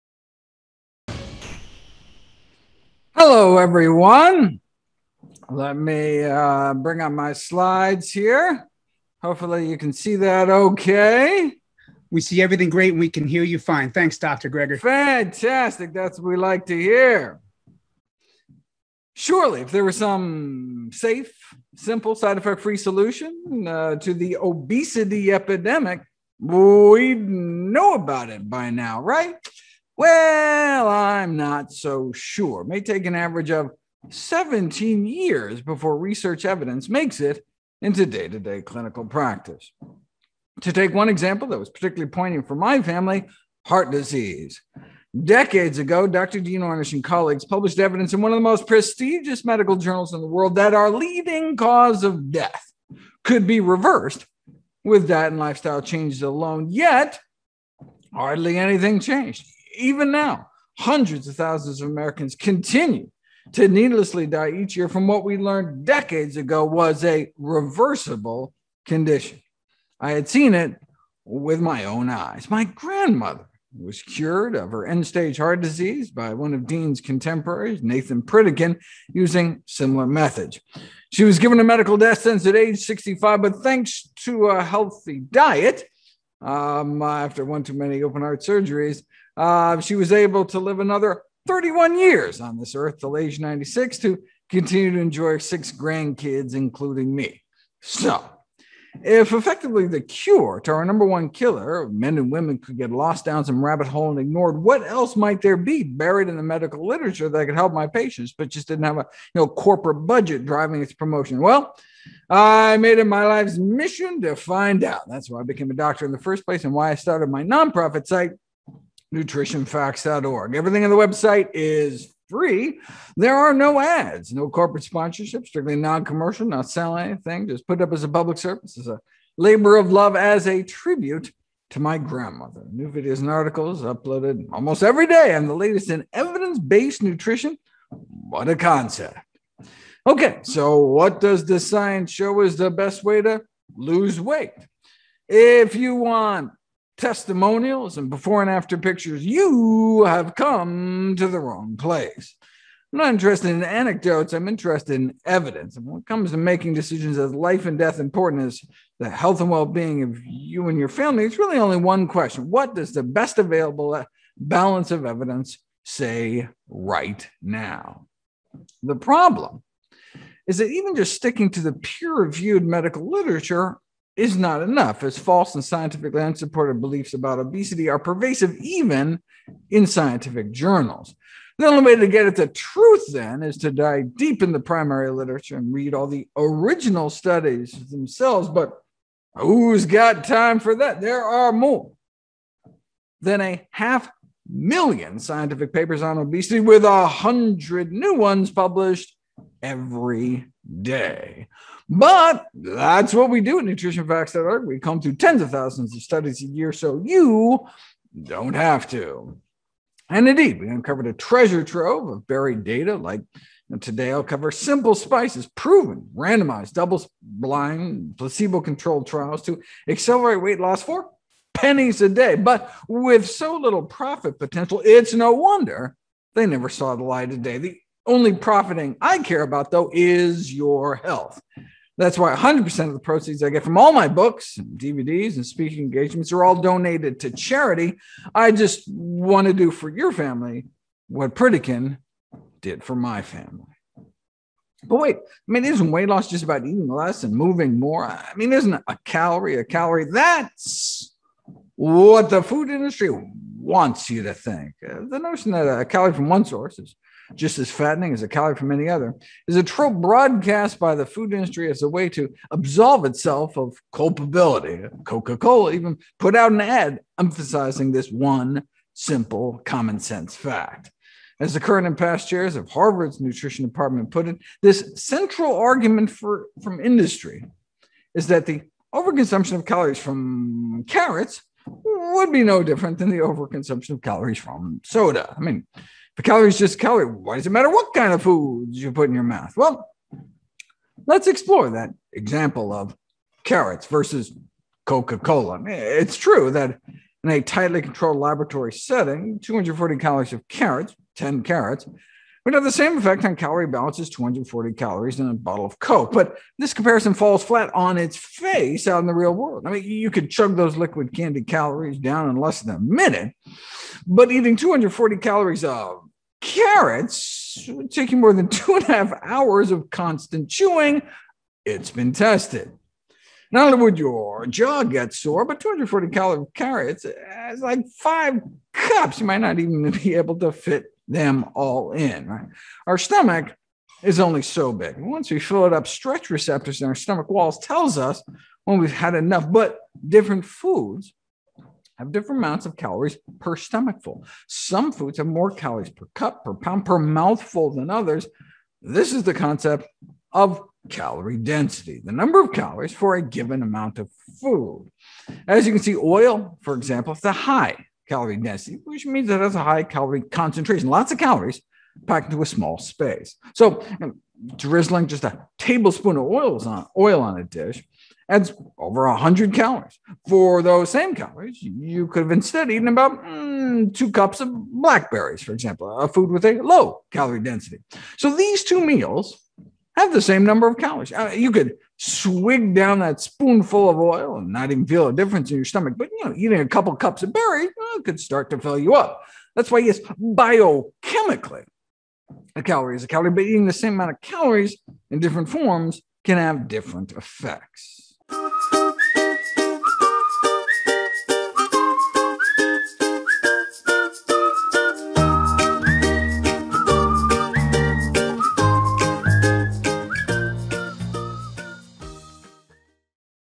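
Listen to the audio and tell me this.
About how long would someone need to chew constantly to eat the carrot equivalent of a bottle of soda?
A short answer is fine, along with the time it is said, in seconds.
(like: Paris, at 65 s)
more than two and a half hours, at 318 s.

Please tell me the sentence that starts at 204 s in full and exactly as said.
We come through tens of thousands of studies a year, so you don't have to.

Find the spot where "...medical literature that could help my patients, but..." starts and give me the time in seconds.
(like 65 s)
106 s.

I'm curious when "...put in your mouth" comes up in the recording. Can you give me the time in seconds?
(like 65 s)
288 s.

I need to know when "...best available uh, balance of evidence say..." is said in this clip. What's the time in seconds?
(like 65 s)
163 s.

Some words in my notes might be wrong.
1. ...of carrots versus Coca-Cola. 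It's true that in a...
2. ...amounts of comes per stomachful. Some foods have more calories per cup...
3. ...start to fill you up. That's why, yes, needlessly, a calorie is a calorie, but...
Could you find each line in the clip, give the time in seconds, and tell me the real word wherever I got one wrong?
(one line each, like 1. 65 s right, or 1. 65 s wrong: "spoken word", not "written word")
1. 292 s right
2. 342 s wrong: "calories", not "comes"
3. 388 s wrong: "biochemically", not "needlessly".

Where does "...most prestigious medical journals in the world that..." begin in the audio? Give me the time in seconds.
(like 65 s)
48 s.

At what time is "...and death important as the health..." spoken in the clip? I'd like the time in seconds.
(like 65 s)
157 s.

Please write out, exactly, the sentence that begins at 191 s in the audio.
There are more than a half million scientific papers on obesity, with a hundred new ones published every day.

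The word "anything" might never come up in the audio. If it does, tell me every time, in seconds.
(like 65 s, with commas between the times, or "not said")
58 s, 127 s.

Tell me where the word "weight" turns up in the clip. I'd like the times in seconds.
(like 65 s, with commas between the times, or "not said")
144 s, 220 s, 245 s.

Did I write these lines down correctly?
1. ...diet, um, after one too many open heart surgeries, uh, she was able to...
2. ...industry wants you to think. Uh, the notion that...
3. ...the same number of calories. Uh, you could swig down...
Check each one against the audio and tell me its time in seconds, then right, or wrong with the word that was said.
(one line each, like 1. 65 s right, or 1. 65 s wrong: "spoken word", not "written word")
1. 85 s right
2. 252 s right
3. 380 s right.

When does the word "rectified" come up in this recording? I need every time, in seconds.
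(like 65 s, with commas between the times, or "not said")
not said.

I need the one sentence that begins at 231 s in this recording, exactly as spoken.
That's why 100% of the proceeds I get from all my books, and DVDs, and speaking engagements are all donated to charity.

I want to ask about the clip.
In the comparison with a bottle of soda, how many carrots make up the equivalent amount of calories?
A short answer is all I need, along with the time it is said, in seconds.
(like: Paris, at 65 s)
10 carrots, at 301 s.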